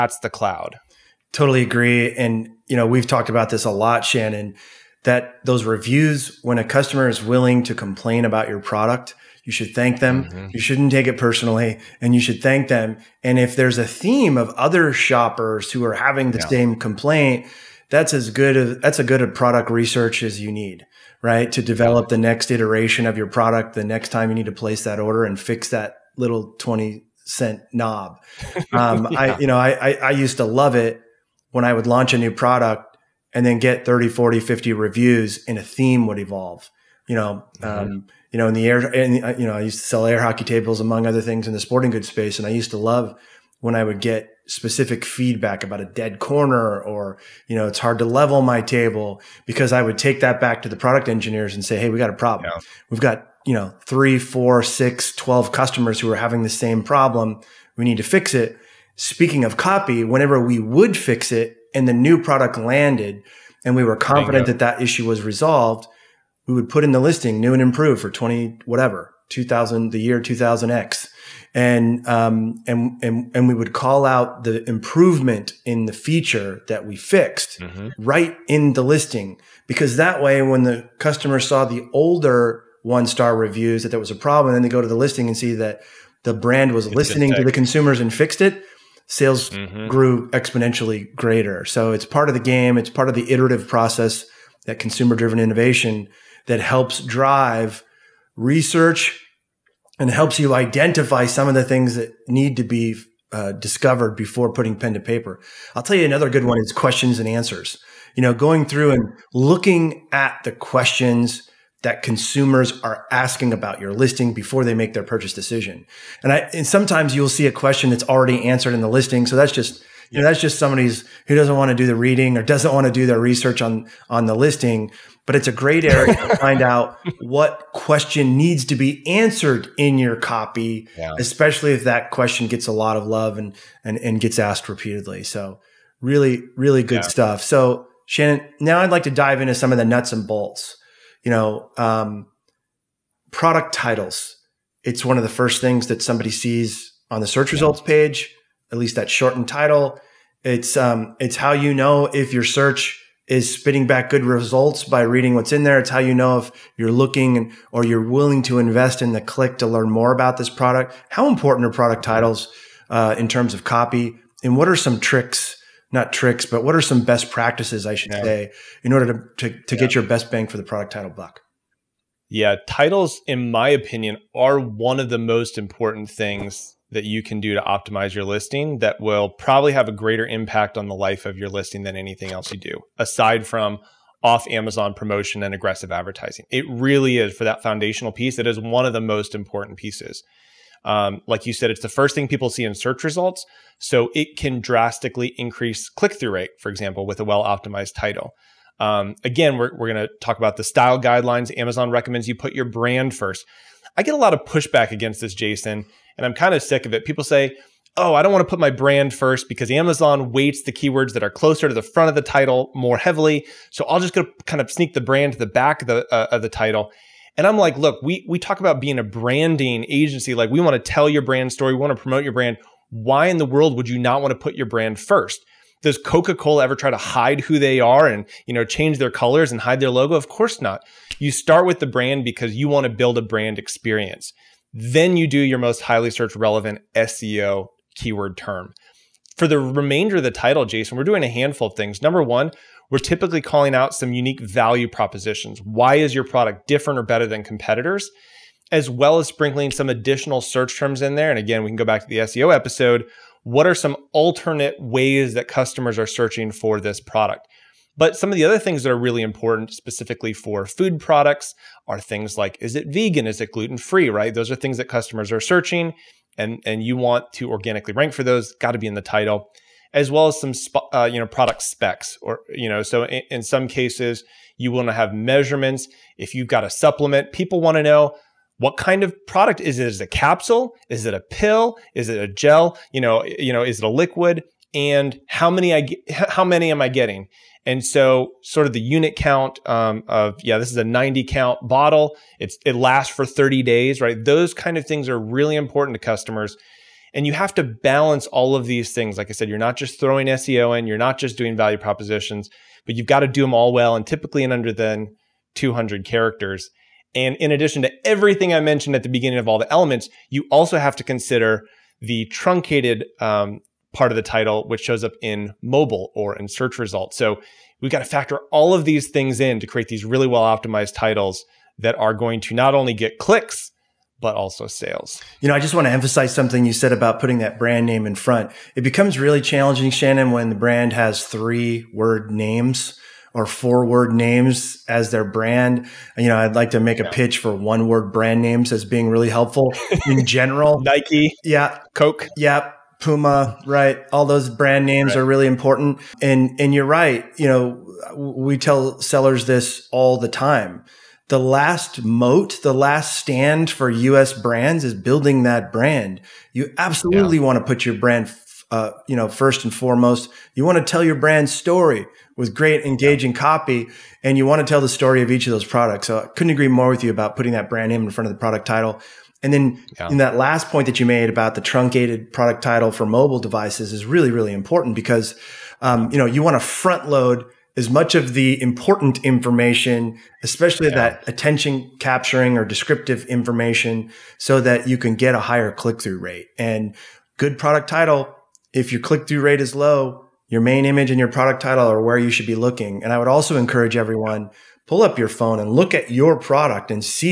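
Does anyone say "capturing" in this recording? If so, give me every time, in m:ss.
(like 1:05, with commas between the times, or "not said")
6:21.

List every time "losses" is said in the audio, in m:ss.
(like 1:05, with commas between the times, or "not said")
not said.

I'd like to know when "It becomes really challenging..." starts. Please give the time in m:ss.
5:28.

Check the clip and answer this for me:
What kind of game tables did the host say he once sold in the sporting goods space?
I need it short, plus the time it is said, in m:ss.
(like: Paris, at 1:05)
air hockey tables, at 0:40.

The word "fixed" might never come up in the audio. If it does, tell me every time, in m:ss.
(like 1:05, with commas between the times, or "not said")
1:16, 1:28.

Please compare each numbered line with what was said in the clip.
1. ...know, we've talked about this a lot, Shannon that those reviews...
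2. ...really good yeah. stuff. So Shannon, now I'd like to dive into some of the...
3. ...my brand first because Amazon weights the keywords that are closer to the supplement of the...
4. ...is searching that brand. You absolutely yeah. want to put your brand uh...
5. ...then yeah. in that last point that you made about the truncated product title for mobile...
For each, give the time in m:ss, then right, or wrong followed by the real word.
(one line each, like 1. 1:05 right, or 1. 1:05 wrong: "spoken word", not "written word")
1. 0:02 right
2. 2:16 right
3. 3:28 wrong: "front", not "supplement"
4. 5:54 wrong: "building", not "searching"
5. 6:09 right.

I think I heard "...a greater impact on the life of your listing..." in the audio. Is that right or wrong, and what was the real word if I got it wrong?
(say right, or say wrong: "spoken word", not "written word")
right.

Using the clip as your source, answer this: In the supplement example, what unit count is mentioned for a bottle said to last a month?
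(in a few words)
90.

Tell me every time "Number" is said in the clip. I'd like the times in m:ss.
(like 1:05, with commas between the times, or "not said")
4:02.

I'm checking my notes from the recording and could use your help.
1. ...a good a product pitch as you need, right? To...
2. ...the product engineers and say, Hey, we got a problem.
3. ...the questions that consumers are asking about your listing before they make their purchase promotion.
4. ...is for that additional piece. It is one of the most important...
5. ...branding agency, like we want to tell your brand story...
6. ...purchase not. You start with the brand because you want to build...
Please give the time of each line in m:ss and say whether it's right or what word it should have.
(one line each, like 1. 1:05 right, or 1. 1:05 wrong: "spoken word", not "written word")
1. 0:18 wrong: "research", not "pitch"
2. 0:50 right
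3. 1:50 wrong: "decision", not "promotion"
4. 3:07 wrong: "foundational", not "additional"
5. 3:39 right
6. 3:50 wrong: "course", not "purchase".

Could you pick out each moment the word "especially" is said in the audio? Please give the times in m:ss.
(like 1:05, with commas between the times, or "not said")
2:11, 6:20.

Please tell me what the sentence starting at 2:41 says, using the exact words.
How important are product titles uh, in terms of copy?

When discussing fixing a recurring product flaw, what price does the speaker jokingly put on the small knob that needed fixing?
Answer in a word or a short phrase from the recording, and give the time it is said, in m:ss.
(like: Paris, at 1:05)
20 cents, at 0:26.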